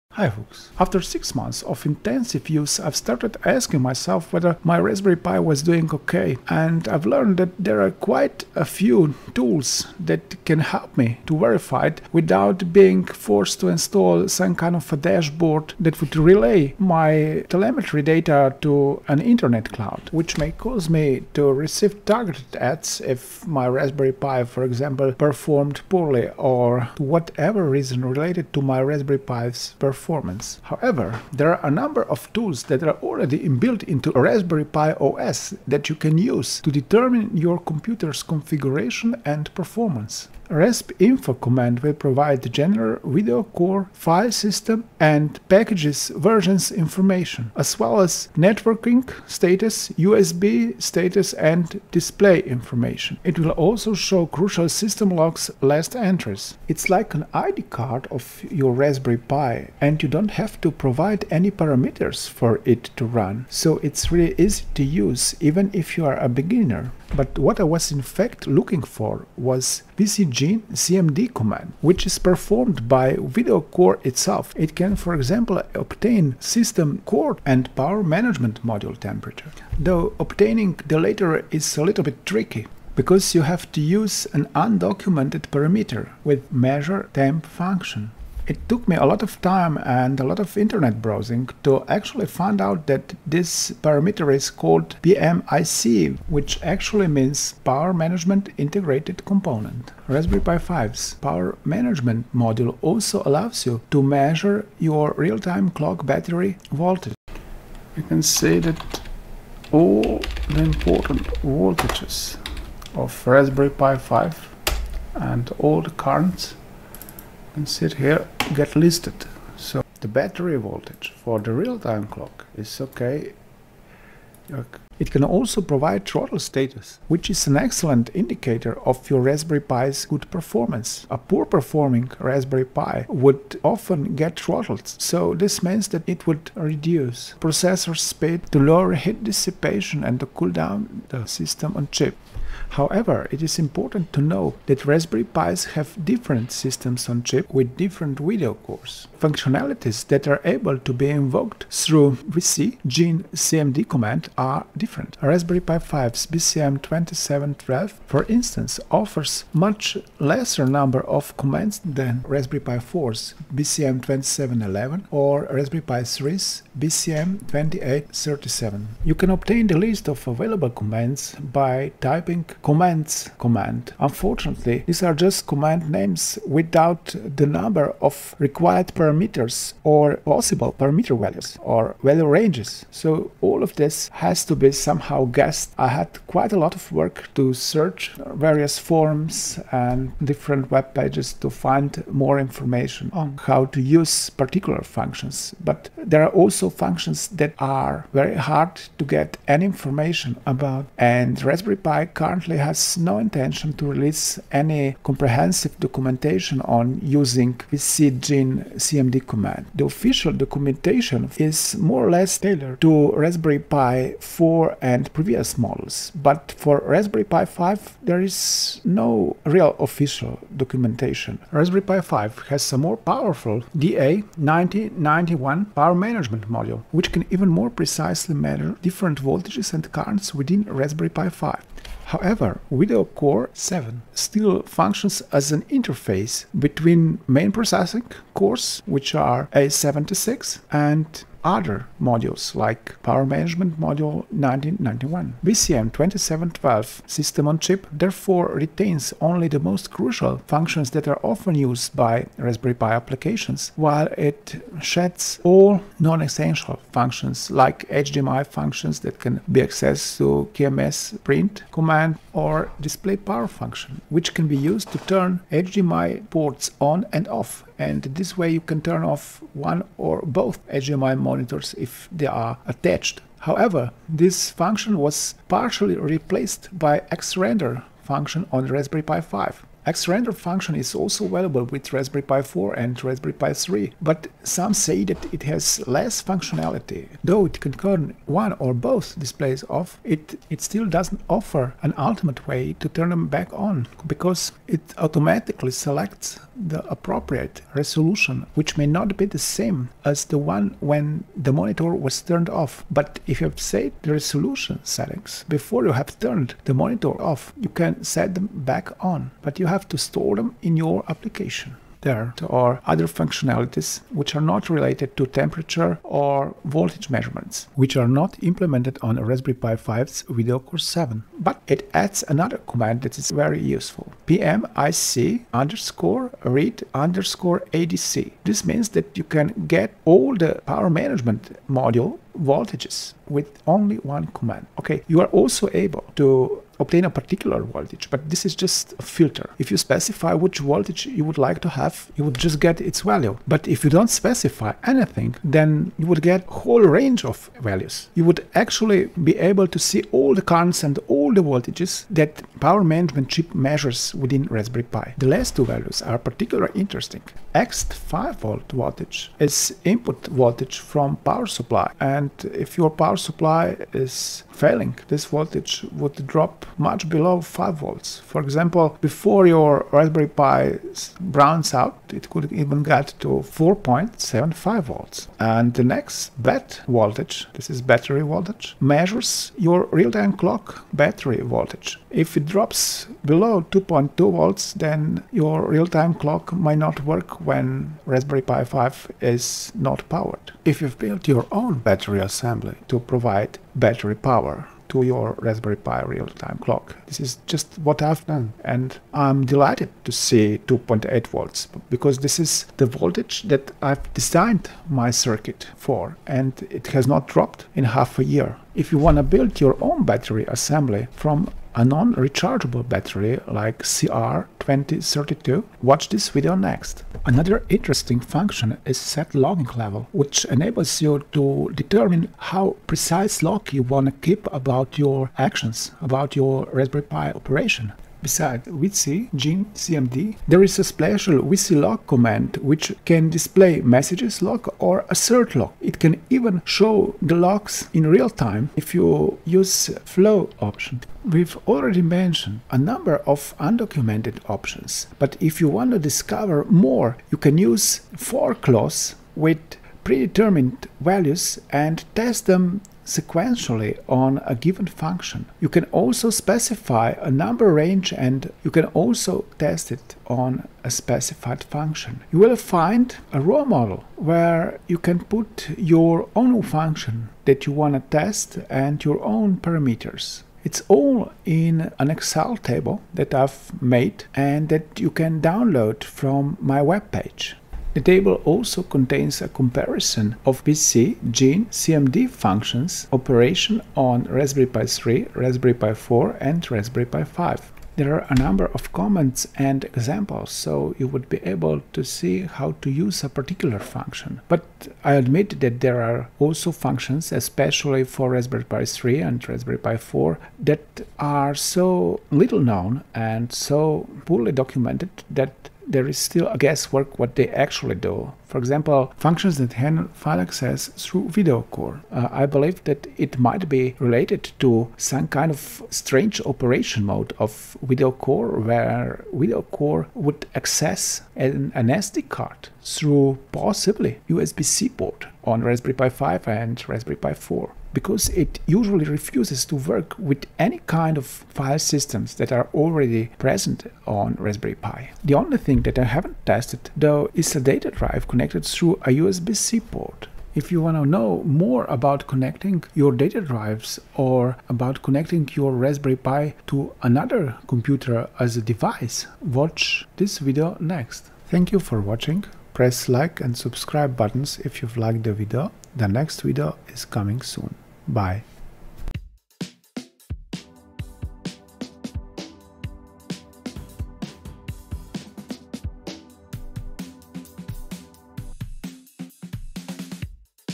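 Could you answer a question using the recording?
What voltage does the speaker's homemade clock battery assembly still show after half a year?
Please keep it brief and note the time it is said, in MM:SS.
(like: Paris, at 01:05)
2.8 volts, at 06:40.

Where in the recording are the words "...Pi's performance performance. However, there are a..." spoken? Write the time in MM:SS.
00:29.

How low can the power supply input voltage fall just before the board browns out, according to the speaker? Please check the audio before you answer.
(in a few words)
4.75 volts.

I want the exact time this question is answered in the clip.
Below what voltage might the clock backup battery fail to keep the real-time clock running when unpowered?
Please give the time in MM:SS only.
06:23.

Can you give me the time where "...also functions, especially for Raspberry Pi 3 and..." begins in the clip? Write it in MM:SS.
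08:16.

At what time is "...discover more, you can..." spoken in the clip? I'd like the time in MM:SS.
07:25.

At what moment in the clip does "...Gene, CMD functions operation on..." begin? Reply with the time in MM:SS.
08:01.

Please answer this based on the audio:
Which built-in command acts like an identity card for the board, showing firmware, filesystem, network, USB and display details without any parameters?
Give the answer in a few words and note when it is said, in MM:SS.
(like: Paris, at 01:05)
raspinfo, at 00:40.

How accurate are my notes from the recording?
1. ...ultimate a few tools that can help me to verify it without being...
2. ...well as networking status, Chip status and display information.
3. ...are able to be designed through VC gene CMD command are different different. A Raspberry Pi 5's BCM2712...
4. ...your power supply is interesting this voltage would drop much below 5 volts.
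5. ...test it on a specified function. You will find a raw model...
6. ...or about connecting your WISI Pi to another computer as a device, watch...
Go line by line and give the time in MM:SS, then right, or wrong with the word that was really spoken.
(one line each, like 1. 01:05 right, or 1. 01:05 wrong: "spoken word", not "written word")
1. 00:07 wrong: "quite", not "ultimate"
2. 00:47 wrong: "USB", not "Chip"
3. 02:30 wrong: "invoked", not "designed"
4. 06:02 wrong: "failing", not "interesting"
5. 07:39 right
6. 09:04 wrong: "Raspberry", not "WISI".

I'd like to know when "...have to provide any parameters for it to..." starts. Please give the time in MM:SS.
01:00.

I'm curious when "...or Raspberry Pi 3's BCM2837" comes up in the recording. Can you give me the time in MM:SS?
02:45.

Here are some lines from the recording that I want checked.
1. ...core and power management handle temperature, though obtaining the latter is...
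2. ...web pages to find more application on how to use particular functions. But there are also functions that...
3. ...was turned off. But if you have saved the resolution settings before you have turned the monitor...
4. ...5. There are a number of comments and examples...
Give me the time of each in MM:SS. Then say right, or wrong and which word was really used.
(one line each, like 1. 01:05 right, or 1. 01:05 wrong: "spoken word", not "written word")
1. 01:17 wrong: "module", not "handle"
2. 03:10 wrong: "information", not "application"
3. 05:01 right
4. 08:07 right.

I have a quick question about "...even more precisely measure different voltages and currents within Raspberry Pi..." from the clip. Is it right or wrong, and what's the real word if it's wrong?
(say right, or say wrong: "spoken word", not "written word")
right.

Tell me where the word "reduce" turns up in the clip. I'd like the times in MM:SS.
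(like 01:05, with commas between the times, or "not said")
02:16.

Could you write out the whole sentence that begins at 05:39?
If you specify which voltage you would like to have, you would just get its value.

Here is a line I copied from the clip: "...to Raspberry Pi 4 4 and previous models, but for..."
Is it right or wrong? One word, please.
right.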